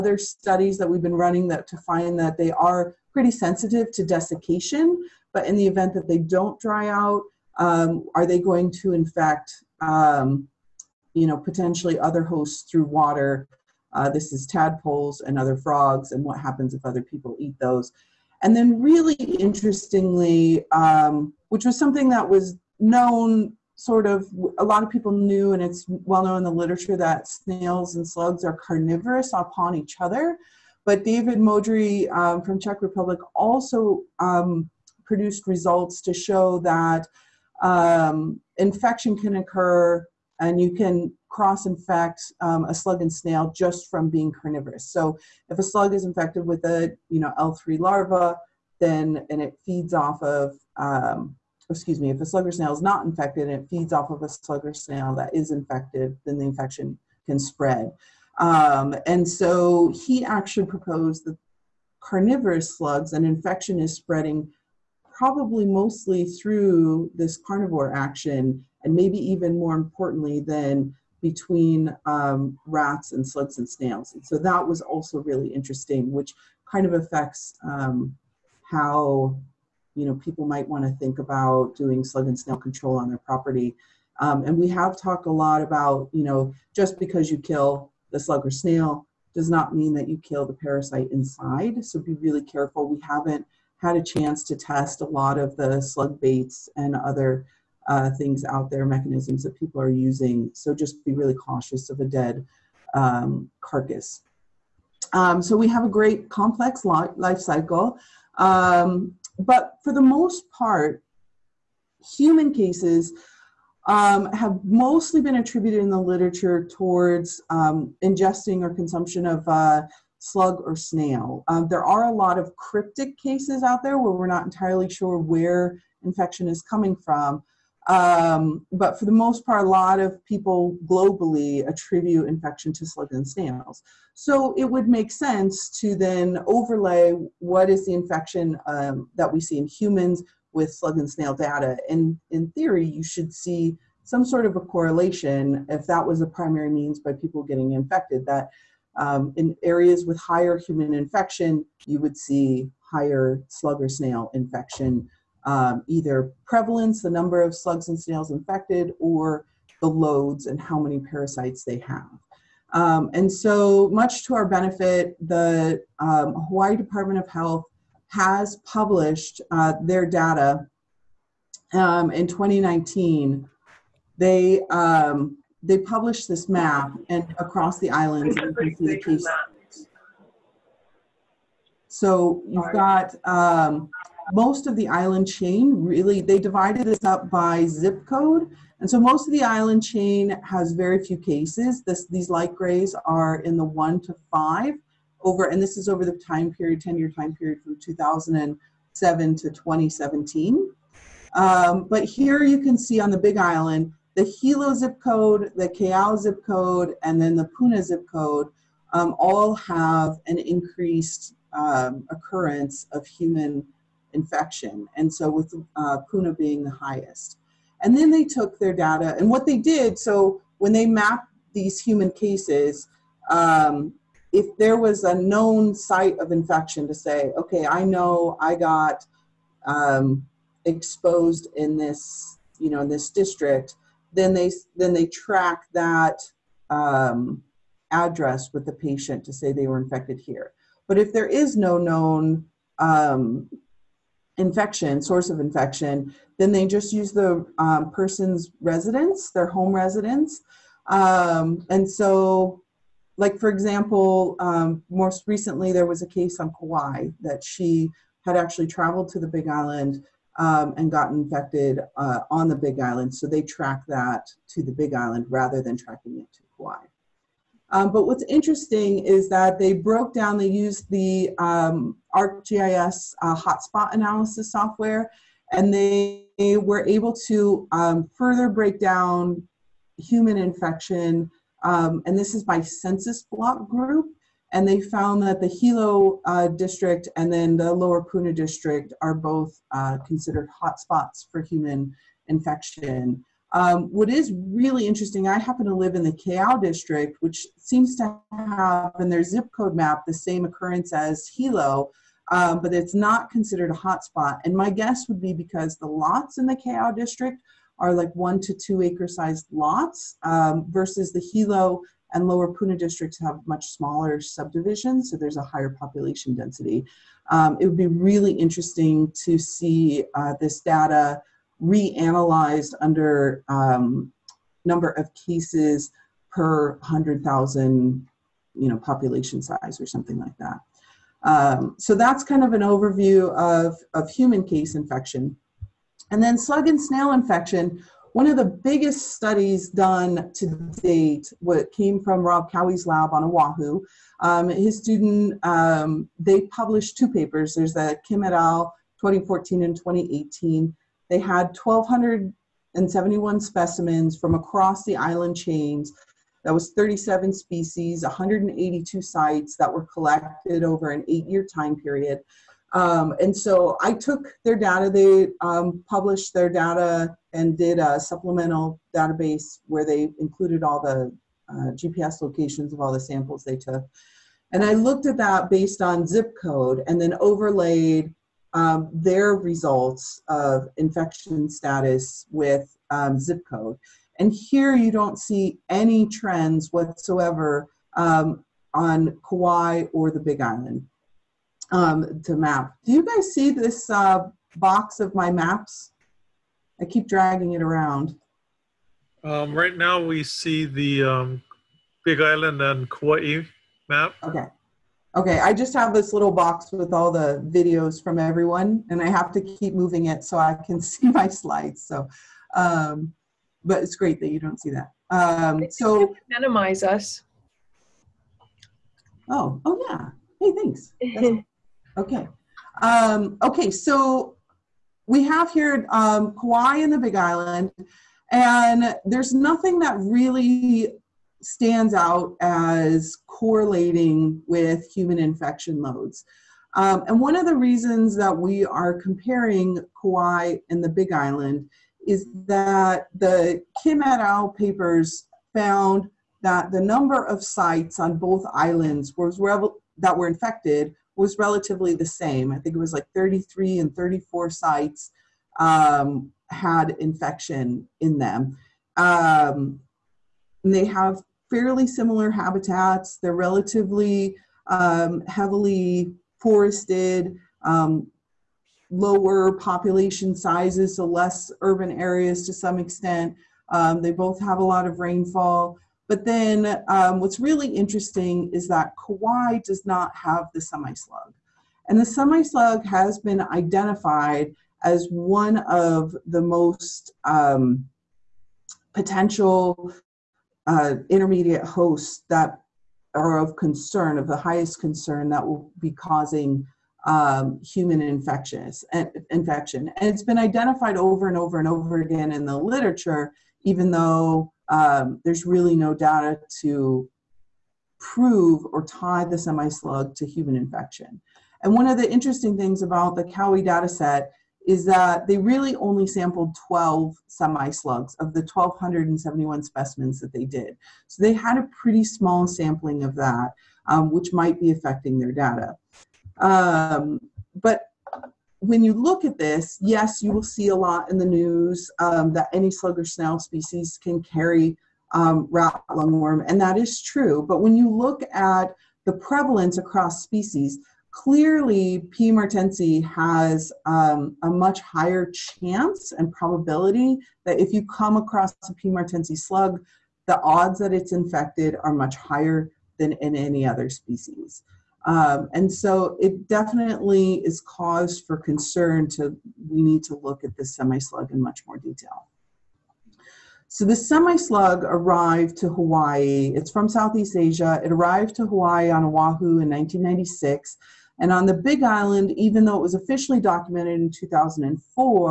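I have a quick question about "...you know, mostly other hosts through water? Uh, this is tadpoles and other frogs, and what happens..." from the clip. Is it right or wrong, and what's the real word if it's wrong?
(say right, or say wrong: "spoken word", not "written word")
wrong: "potentially", not "mostly".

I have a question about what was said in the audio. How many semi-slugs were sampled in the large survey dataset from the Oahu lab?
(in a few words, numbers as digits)
12.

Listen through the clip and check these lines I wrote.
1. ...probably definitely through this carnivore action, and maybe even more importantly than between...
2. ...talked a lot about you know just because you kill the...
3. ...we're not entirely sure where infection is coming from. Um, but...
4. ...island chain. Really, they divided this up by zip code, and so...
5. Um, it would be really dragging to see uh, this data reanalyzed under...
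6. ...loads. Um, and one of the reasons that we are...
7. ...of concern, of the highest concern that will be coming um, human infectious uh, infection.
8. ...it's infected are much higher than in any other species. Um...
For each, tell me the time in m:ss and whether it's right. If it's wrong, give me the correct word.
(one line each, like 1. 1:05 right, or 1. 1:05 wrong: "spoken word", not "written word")
1. 1:05 wrong: "mostly", not "definitely"
2. 1:24 right
3. 2:04 right
4. 3:04 right
5. 5:17 wrong: "interesting", not "dragging"
6. 7:15 right
7. 8:13 wrong: "causing", not "coming"
8. 9:10 right.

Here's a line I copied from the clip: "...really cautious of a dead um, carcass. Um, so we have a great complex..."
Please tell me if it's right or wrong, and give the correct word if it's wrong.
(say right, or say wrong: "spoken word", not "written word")
right.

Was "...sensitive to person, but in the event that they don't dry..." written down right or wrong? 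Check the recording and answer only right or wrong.
wrong.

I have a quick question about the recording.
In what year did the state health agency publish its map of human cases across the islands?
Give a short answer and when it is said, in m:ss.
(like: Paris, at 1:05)
2019, at 2:52.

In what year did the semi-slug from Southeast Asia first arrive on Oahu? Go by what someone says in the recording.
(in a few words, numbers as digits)
1996.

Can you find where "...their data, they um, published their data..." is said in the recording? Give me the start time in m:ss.
6:04.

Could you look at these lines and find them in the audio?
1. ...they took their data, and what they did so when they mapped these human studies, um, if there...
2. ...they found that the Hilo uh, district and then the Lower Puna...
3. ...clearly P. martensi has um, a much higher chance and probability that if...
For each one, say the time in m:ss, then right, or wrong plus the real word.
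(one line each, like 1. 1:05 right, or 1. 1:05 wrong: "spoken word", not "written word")
1. 3:38 wrong: "cases", not "studies"
2. 4:44 right
3. 9:01 right.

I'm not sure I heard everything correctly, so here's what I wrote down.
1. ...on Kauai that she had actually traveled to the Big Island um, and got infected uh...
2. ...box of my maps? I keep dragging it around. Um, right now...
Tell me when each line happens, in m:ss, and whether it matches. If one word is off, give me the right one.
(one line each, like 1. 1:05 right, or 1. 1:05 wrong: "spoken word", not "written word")
1. 4:16 right
2. 6:34 right.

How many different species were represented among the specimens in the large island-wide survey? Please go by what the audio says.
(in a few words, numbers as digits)
37.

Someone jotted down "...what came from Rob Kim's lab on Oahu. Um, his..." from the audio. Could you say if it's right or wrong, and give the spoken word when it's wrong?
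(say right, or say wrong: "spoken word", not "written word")
wrong: "Cowie", not "Kim".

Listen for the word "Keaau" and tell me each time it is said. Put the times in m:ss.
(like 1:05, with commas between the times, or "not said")
3:25, 4:56, 5:06.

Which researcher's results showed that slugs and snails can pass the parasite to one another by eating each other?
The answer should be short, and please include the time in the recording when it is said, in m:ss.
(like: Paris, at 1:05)
David Modry, at 0:31.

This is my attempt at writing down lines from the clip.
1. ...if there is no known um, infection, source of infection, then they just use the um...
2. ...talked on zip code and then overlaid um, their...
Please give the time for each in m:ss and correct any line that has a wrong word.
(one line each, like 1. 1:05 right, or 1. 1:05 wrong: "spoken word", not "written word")
1. 4:00 right
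2. 6:15 wrong: "based", not "talked".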